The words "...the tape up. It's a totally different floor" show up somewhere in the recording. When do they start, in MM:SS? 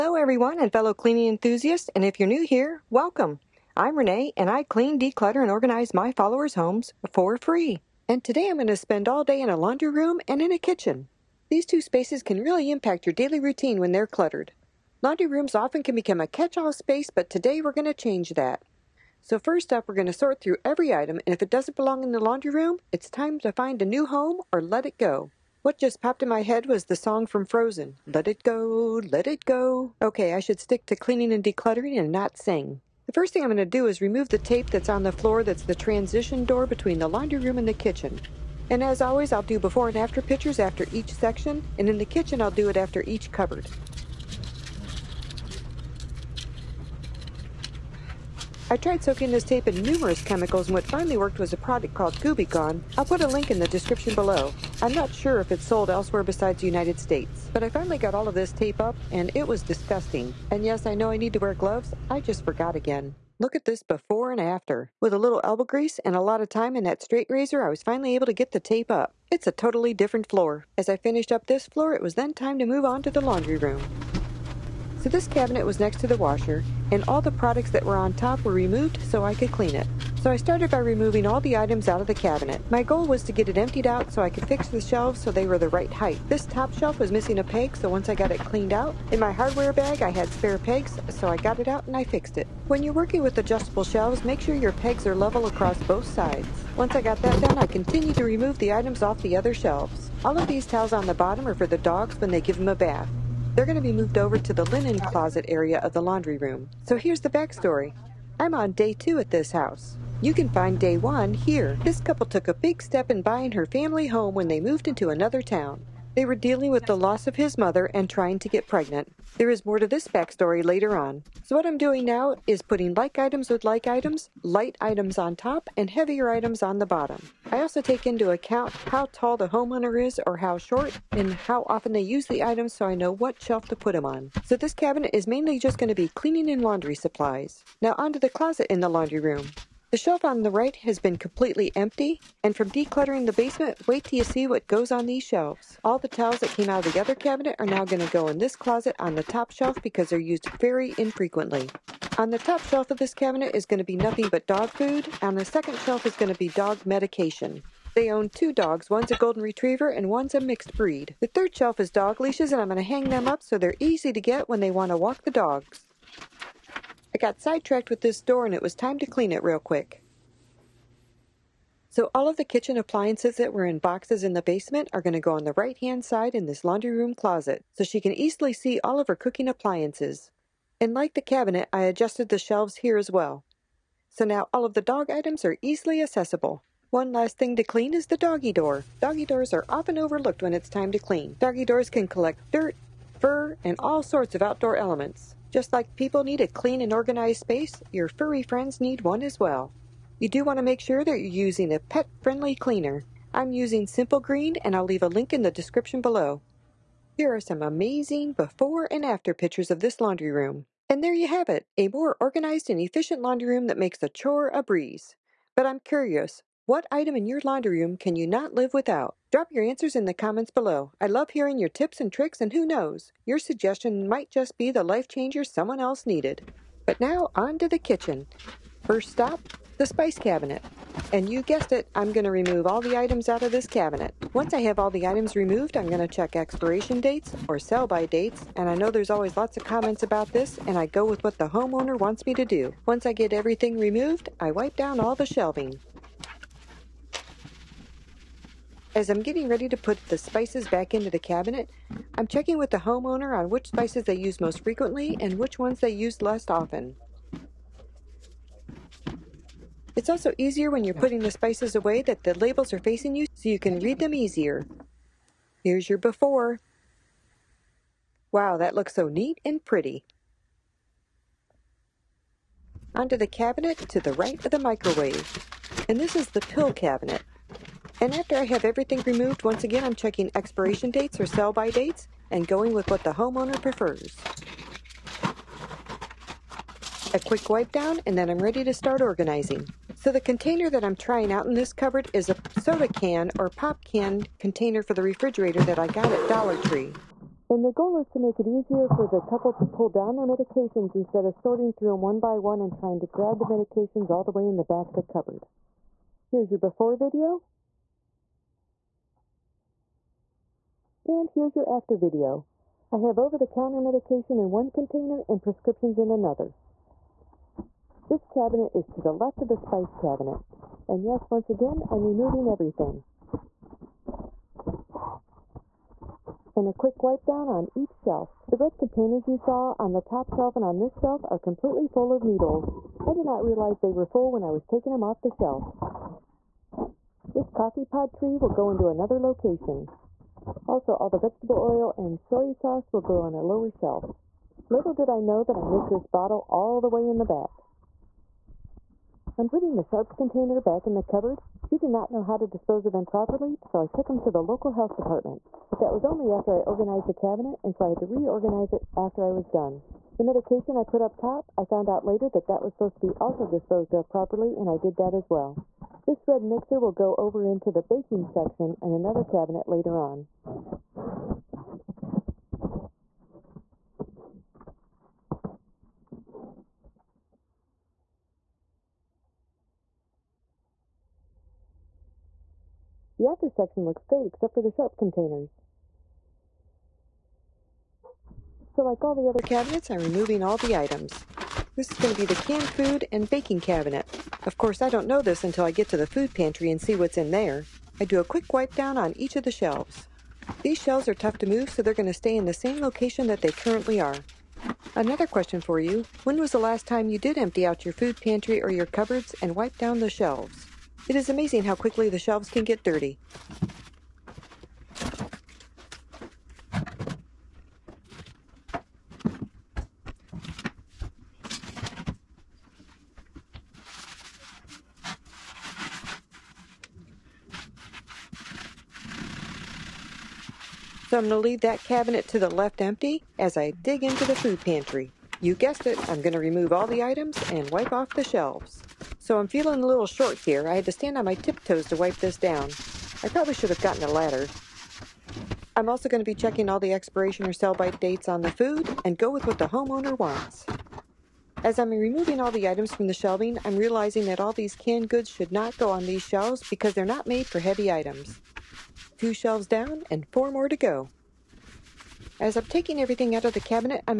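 01:08.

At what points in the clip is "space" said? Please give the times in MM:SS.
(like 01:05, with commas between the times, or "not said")
00:11, 00:16, 03:17.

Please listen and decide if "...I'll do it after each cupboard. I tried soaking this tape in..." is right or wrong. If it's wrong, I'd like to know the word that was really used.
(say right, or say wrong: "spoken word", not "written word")
right.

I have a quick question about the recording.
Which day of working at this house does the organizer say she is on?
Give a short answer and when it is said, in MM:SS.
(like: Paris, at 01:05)
day two, at 01:48.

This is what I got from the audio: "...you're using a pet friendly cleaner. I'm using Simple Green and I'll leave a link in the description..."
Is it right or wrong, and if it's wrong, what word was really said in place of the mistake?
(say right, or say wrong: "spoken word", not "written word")
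right.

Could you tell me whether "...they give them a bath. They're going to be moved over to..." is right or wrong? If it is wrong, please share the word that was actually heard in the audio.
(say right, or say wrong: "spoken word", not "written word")
right.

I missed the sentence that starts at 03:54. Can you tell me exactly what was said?
Once I have all the items removed, I'm going to check expiration dates or sell by dates.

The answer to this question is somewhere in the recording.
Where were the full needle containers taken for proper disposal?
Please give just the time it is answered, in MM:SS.
05:54.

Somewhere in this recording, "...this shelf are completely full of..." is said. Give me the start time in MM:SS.
05:30.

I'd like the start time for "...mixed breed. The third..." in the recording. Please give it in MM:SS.
02:40.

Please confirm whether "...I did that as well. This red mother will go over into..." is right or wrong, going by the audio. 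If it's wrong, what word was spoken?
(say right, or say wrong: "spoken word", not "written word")
wrong: "mixer", not "mother".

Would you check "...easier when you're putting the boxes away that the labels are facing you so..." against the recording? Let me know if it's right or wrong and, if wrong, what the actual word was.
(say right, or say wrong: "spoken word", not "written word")
wrong: "spices", not "boxes".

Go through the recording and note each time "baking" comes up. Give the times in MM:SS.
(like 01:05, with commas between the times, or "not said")
06:07, 06:33.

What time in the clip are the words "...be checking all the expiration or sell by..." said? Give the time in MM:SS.
07:26.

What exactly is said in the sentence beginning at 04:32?
Onto the cabinet to the right of the microwave.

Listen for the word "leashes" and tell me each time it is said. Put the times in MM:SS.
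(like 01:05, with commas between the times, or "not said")
02:42.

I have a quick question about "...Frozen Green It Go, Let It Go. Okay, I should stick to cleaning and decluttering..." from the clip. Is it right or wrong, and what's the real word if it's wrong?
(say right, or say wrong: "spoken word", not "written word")
wrong: "Let", not "Green".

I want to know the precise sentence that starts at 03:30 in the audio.
And there you have it, a more organized and efficient laundry room that makes a chore a breeze.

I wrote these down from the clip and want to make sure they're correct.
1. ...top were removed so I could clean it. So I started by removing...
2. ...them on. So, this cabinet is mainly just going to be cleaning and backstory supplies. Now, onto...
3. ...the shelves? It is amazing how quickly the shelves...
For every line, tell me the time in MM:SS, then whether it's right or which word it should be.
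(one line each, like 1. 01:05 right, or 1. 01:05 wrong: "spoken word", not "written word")
1. 01:18 right
2. 02:13 wrong: "laundry", not "backstory"
3. 06:50 right.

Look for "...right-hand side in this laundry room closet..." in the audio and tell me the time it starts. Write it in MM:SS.
02:55.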